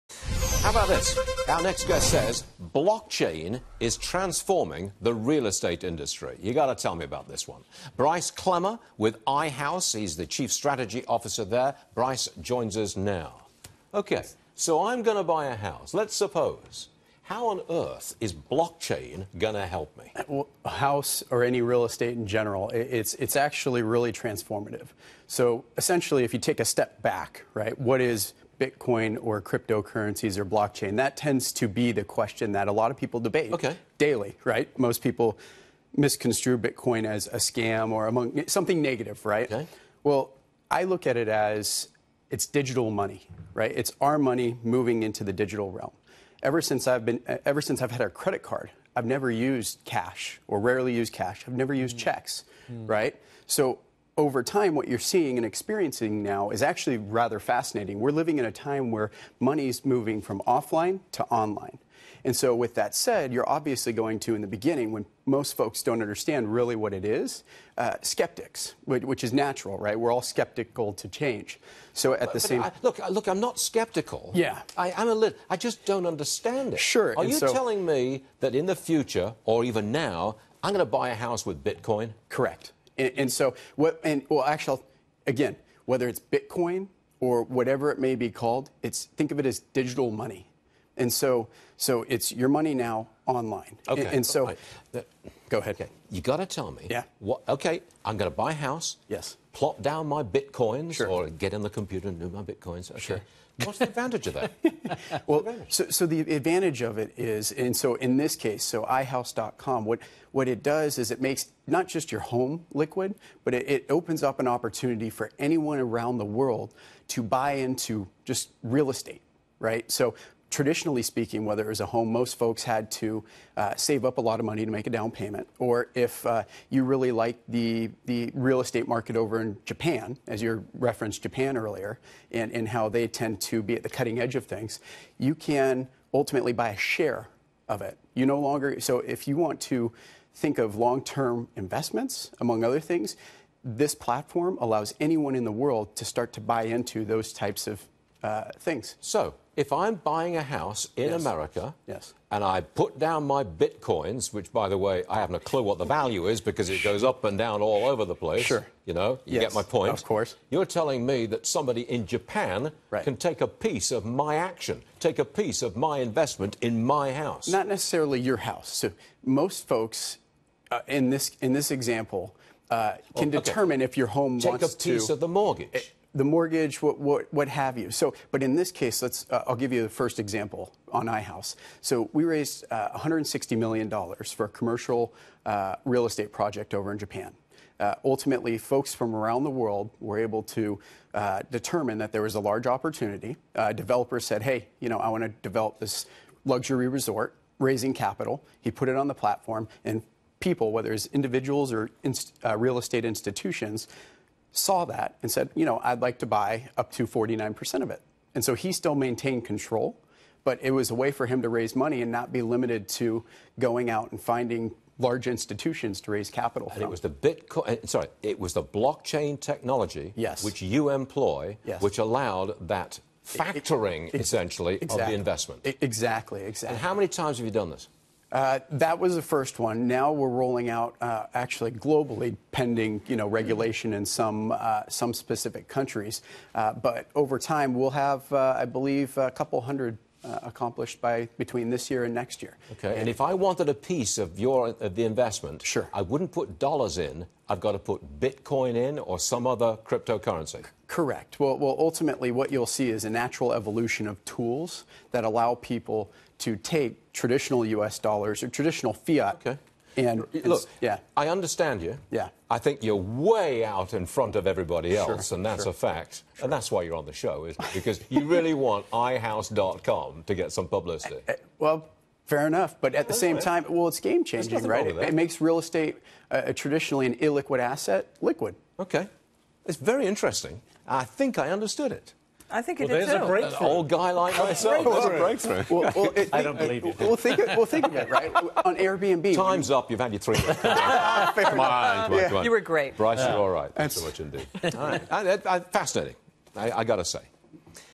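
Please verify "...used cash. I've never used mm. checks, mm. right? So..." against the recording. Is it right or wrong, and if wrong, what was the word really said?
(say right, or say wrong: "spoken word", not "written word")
right.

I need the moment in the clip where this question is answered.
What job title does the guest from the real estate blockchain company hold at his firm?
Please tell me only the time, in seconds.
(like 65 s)
10 s.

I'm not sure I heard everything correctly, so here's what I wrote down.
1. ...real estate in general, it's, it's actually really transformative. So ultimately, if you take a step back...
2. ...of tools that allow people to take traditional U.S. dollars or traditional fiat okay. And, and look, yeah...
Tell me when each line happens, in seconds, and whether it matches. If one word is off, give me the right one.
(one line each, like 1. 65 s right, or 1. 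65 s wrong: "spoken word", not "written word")
1. 21 s wrong: "essentially", not "ultimately"
2. 254 s right.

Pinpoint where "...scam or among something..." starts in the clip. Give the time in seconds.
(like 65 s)
37 s.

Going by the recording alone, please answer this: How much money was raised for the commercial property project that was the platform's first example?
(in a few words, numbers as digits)
$160 million.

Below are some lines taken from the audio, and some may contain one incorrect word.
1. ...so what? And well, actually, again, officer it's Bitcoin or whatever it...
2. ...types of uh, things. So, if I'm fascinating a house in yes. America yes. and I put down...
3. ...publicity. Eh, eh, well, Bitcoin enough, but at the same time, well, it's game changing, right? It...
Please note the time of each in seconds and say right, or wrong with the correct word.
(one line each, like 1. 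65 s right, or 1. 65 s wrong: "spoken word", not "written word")
1. 83 s wrong: "whether", not "officer"
2. 147 s wrong: "buying", not "fascinating"
3. 270 s wrong: "Fair", not "Bitcoin".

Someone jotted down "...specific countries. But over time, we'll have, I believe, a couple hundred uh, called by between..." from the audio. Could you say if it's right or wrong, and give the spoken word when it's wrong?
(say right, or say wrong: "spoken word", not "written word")
wrong: "accomplished", not "called".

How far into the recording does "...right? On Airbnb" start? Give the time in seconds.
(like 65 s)
288 s.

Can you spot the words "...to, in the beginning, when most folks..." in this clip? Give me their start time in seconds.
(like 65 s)
64 s.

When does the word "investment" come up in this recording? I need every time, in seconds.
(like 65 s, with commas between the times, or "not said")
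141 s, 165 s, 225 s, 245 s.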